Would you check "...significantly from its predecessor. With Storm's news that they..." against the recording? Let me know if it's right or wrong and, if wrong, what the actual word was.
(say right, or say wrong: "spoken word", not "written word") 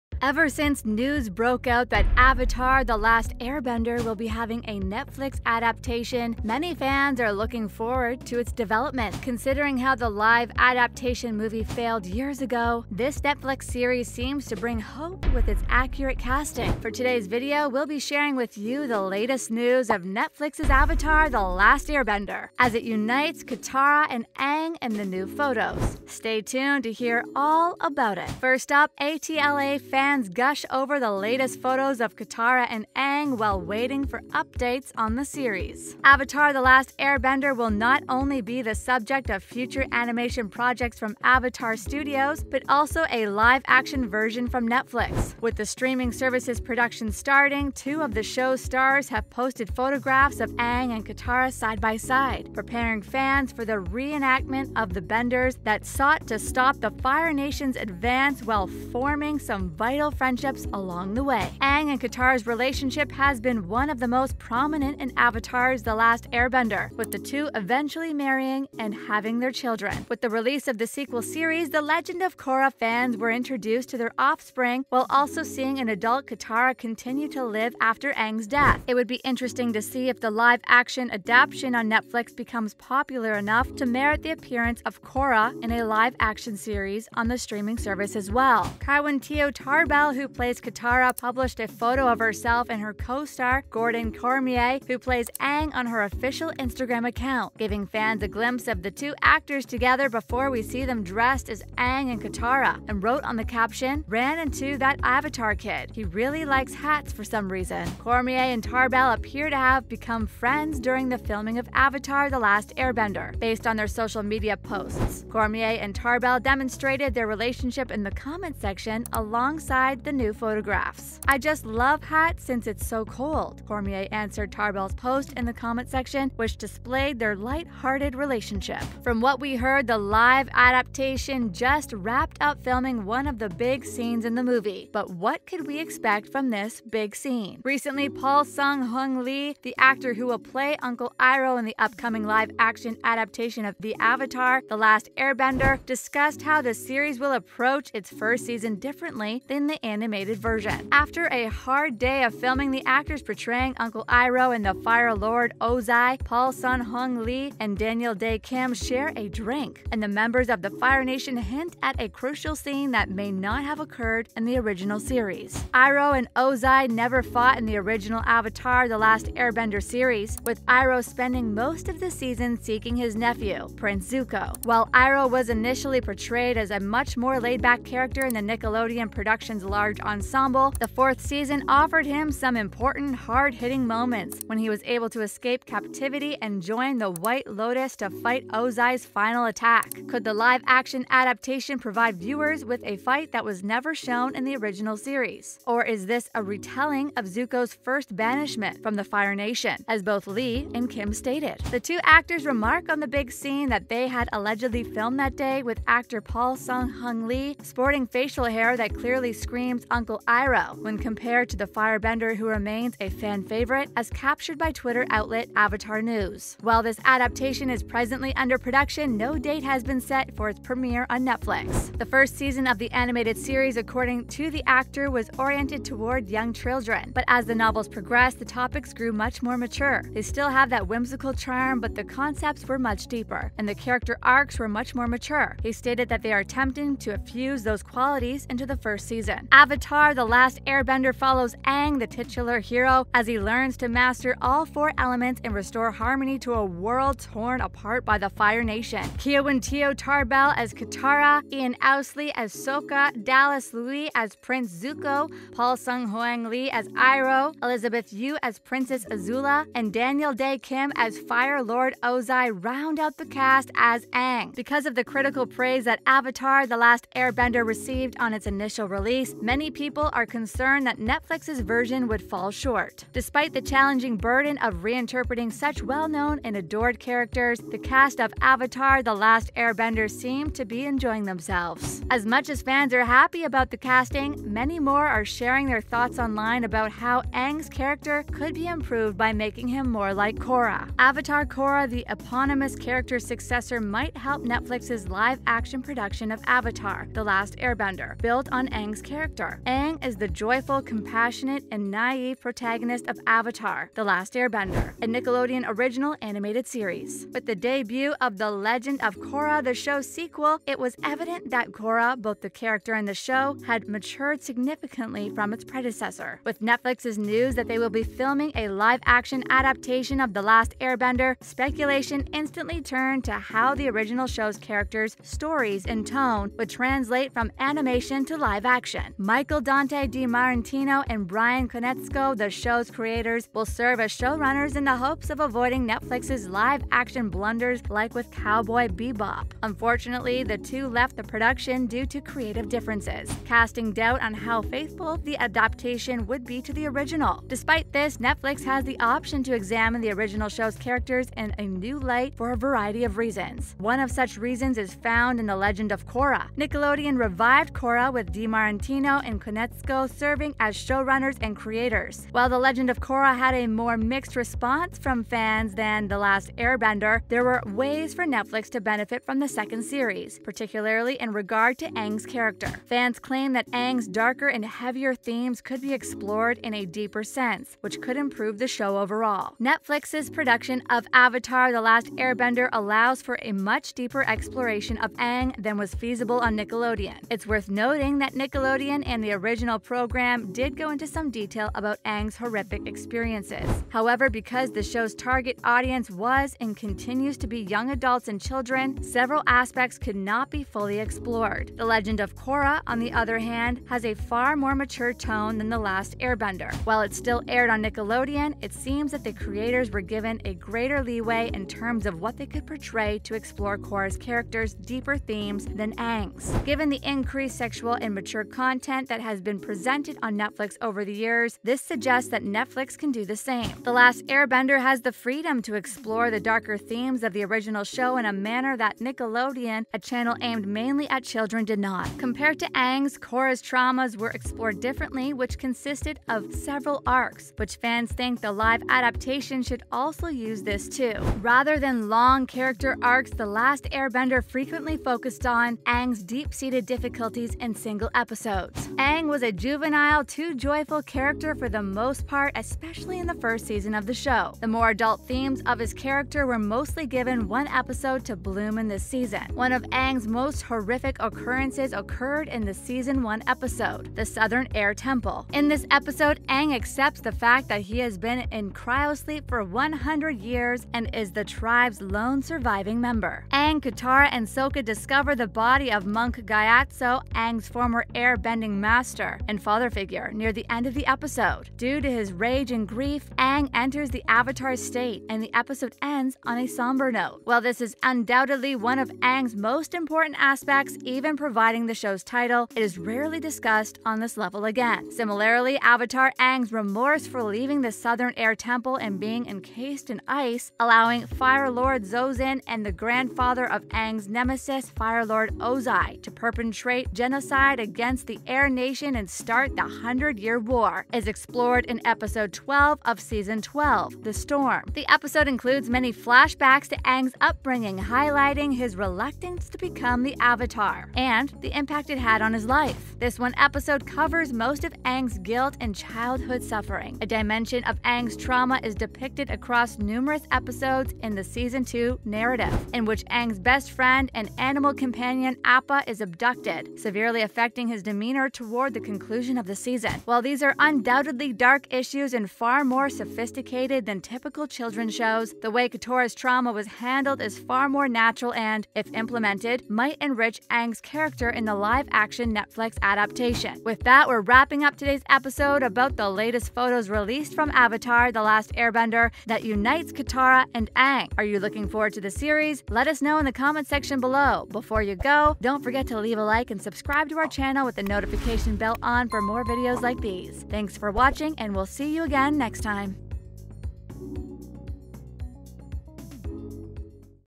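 wrong: "Netflix", not "Storm".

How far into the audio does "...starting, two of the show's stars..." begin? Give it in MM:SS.
00:47.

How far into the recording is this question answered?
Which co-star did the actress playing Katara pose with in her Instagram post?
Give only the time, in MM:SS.
01:33.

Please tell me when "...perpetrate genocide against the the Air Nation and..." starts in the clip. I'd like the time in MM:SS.
08:26.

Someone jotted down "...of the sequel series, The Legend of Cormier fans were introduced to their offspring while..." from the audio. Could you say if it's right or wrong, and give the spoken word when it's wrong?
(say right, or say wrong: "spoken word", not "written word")
wrong: "Korra", not "Cormier".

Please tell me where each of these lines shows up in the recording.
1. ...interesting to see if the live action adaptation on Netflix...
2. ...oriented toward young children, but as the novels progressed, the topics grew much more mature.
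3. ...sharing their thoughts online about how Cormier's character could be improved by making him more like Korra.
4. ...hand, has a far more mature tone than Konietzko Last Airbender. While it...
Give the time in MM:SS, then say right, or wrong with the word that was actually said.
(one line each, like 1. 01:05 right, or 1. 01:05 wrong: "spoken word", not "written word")
1. 01:19 right
2. 03:45 right
3. 04:45 wrong: "Aang", not "Cormier"
4. 06:43 wrong: "The", not "Konietzko".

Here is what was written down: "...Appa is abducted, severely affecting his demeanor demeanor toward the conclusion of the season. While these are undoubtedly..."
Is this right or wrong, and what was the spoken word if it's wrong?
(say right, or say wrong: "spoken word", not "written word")
right.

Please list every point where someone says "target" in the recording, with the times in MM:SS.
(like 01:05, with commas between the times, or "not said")
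06:35.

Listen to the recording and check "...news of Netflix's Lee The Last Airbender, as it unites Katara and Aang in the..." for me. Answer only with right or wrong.
wrong.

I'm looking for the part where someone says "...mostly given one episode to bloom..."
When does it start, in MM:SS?
07:36.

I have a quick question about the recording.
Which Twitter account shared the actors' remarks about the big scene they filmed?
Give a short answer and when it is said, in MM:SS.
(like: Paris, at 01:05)
Avatar News, at 03:35.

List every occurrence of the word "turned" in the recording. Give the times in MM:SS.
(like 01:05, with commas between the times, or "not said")
05:22.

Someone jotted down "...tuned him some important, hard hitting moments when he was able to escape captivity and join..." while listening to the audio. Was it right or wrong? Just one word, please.
wrong.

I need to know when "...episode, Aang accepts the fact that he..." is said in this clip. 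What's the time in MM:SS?
07:45.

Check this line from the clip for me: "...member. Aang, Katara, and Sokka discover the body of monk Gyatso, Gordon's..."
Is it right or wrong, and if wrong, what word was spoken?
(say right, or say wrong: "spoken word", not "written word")
wrong: "Aang", not "Gordon".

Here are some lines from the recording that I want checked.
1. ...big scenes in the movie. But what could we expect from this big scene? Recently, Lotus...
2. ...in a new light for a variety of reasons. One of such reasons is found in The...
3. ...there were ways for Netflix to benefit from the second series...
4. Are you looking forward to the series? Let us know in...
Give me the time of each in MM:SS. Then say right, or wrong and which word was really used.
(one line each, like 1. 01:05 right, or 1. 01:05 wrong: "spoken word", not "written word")
1. 02:13 wrong: "Paul", not "Lotus"
2. 05:51 right
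3. 06:07 right
4. 09:21 right.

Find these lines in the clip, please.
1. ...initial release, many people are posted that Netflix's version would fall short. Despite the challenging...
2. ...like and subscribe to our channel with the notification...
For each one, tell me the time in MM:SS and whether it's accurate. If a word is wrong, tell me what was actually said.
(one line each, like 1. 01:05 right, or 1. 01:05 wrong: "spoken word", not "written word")
1. 04:28 wrong: "concerned", not "posted"
2. 09:26 right.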